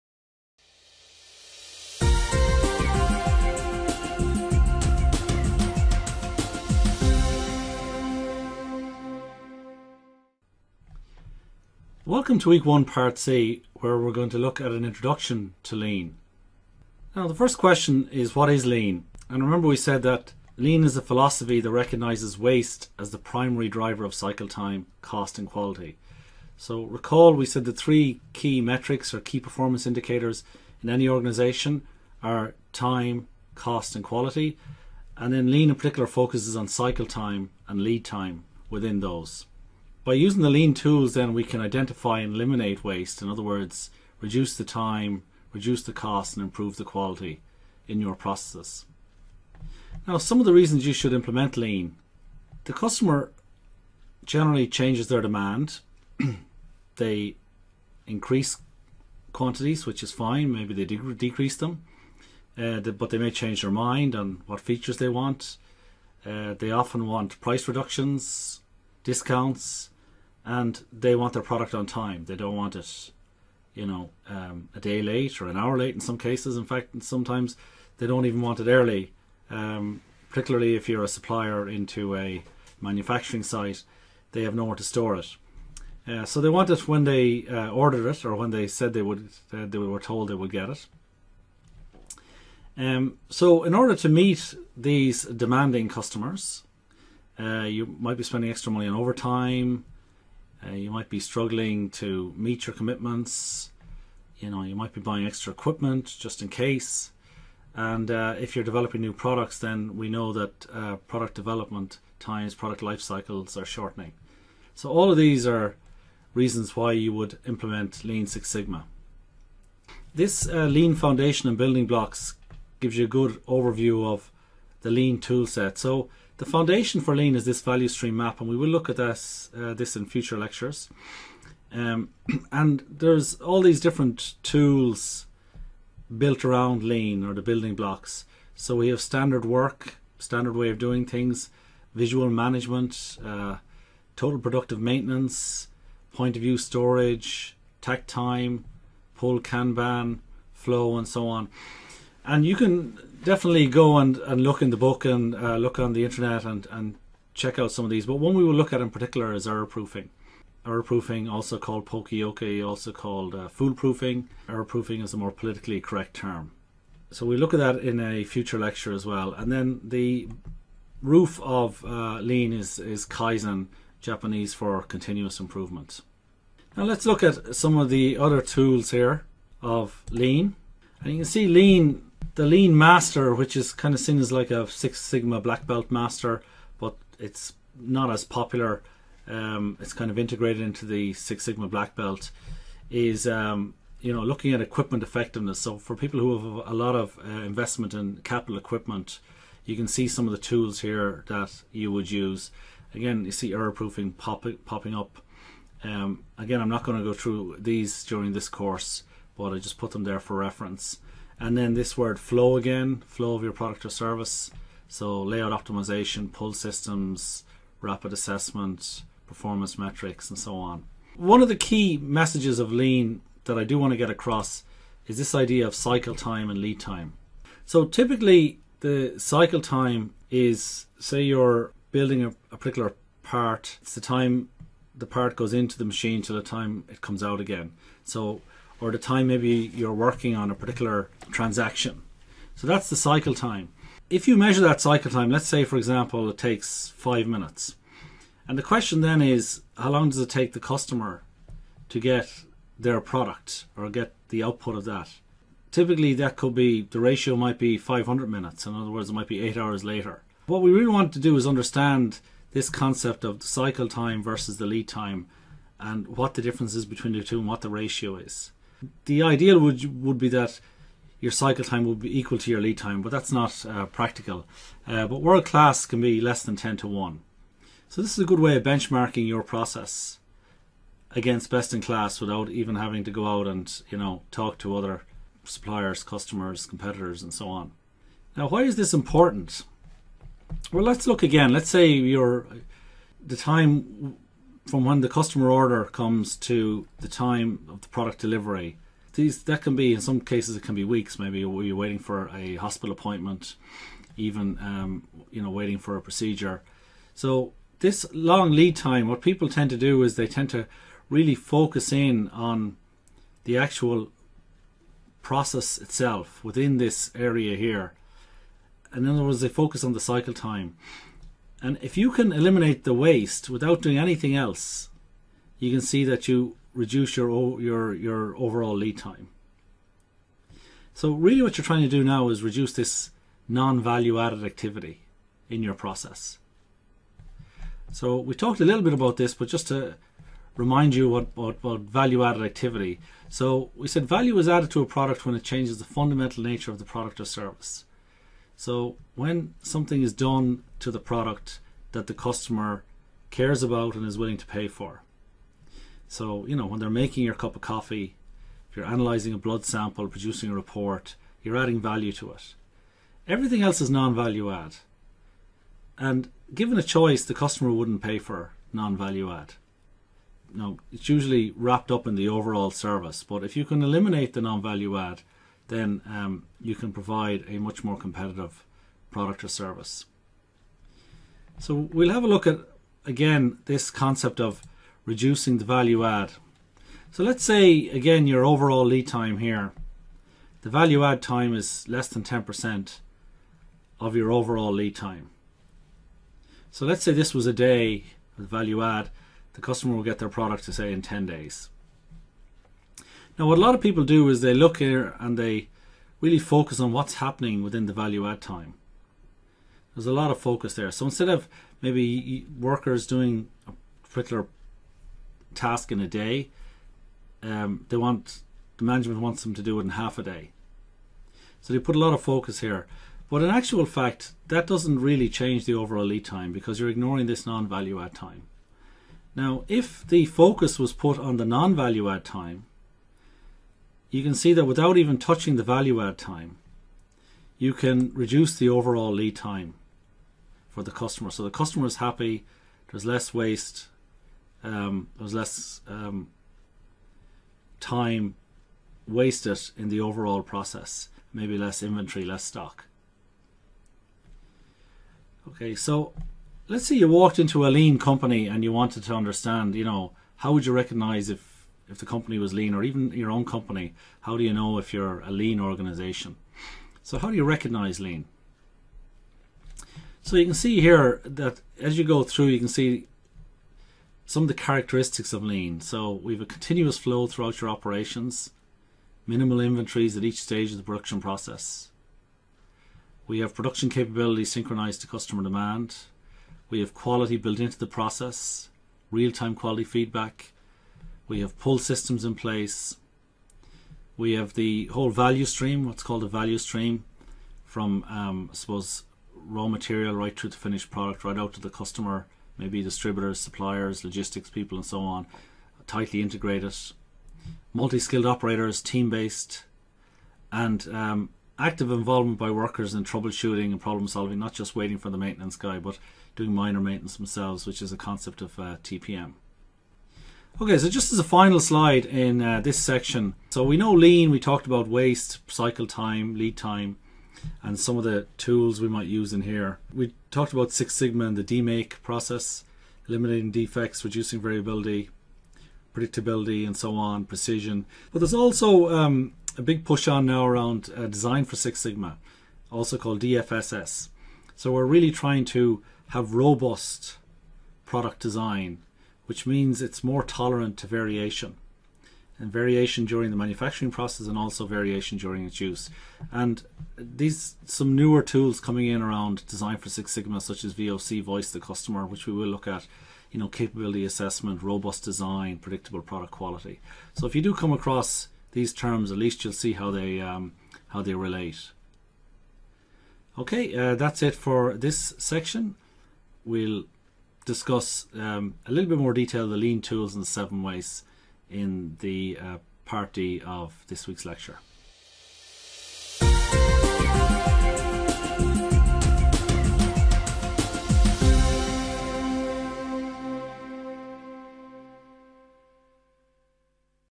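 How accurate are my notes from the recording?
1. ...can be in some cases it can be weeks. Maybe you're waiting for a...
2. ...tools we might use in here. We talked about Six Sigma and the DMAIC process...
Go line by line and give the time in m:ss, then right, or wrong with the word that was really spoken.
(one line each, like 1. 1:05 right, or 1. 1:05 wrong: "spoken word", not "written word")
1. 4:59 right
2. 8:48 right.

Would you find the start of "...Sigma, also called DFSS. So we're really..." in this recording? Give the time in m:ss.
9:01.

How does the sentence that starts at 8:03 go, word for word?
We have production capabilities synchronized to customer demand.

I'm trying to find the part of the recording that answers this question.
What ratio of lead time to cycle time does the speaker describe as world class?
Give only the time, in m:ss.
4:36.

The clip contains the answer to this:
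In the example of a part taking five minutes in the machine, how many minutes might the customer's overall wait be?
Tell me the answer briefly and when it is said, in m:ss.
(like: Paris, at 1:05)
500 minutes, at 4:17.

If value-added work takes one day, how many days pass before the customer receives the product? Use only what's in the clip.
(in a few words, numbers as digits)
10 days.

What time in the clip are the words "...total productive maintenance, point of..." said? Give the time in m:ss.
2:24.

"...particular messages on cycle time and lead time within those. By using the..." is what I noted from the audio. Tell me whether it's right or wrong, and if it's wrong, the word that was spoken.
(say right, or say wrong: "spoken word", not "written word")
wrong: "focuses", not "messages".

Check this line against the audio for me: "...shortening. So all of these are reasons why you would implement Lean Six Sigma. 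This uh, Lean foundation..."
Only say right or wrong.
right.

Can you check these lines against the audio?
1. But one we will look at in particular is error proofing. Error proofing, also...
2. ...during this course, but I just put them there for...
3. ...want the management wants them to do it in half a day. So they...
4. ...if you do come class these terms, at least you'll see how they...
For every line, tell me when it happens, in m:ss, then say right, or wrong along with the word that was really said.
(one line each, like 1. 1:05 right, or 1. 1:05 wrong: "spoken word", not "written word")
1. 2:38 right
2. 3:28 right
3. 6:57 right
4. 9:27 wrong: "across", not "class".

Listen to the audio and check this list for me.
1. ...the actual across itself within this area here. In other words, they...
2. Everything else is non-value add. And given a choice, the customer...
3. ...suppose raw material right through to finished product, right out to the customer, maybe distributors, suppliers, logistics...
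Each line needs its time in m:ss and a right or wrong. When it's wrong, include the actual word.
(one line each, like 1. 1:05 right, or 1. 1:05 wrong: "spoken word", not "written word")
1. 5:13 wrong: "process", not "across"
2. 6:03 right
3. 8:18 right.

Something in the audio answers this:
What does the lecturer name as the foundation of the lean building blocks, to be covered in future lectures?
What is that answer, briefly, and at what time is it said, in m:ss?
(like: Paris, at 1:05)
Value stream map, at 2:07.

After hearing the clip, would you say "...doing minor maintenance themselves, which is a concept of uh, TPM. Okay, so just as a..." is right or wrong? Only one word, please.
right.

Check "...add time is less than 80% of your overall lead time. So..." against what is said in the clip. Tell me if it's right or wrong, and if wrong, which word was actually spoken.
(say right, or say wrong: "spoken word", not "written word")
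wrong: "10", not "80".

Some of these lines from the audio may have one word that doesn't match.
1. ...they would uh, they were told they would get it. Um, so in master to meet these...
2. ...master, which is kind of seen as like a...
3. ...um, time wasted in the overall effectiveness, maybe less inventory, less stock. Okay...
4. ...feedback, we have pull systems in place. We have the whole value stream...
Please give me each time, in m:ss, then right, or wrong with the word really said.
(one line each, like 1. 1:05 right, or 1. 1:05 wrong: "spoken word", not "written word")
1. 1:28 wrong: "order", not "master"
2. 3:02 right
3. 7:25 wrong: "process", not "effectiveness"
4. 8:09 right.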